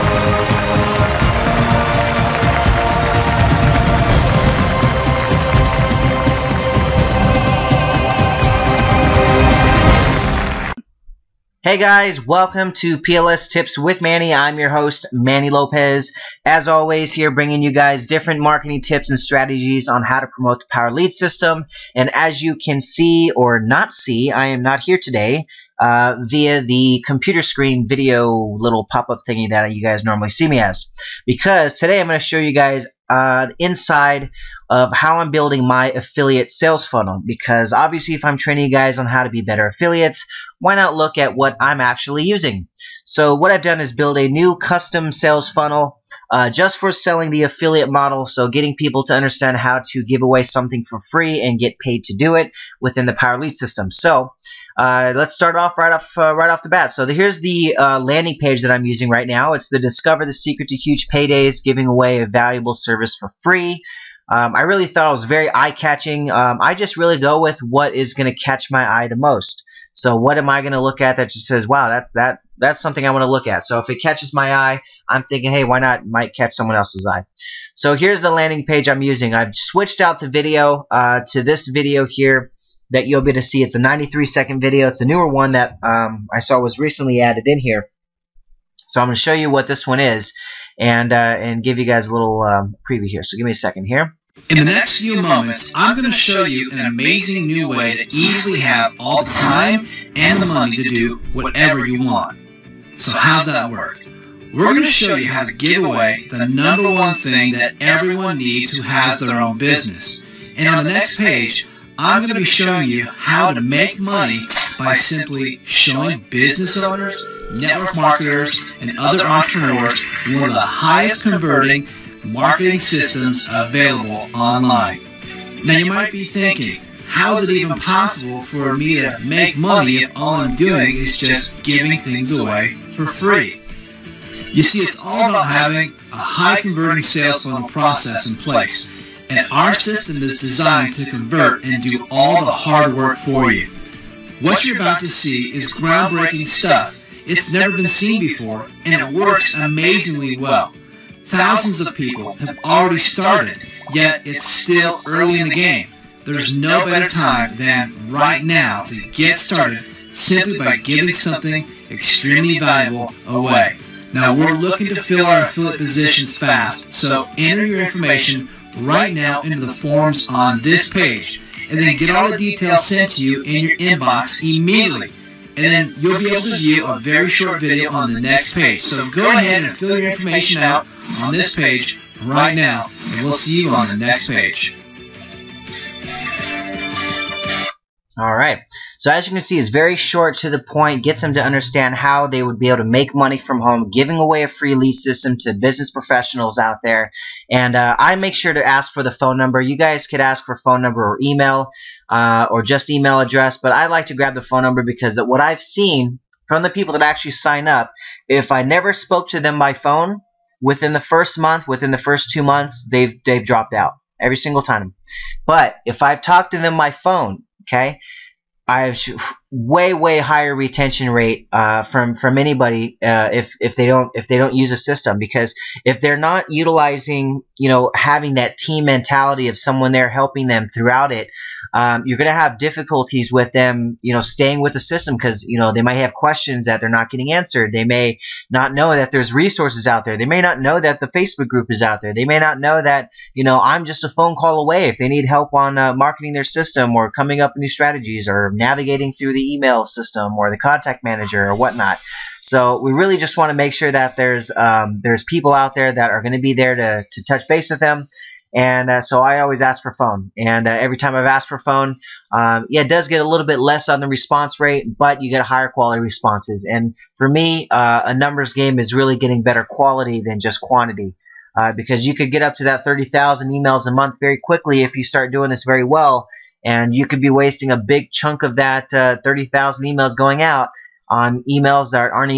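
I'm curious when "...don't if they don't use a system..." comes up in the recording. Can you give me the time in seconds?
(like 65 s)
223 s.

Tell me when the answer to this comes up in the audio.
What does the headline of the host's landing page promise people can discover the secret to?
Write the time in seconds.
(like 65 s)
60 s.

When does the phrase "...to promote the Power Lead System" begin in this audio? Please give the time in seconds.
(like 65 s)
20 s.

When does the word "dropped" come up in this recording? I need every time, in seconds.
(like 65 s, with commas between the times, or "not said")
213 s.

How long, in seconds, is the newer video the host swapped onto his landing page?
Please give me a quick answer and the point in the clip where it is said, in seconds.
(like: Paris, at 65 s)
93, at 83 s.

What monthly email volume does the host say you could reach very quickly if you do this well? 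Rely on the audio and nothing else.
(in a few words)
30,000.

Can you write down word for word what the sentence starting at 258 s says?
And uh, so I always ask for phone.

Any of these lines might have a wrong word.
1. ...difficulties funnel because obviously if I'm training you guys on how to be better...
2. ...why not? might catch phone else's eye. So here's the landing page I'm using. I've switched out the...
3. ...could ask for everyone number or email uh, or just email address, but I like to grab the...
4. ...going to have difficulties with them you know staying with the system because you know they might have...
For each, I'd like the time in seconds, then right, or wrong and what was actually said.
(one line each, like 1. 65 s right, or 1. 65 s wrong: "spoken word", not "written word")
1. 36 s wrong: "sales", not "difficulties"
2. 75 s wrong: "someone", not "phone"
3. 200 s wrong: "phone", not "everyone"
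4. 232 s right.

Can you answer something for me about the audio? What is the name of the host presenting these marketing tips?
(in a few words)
Manny Lopez.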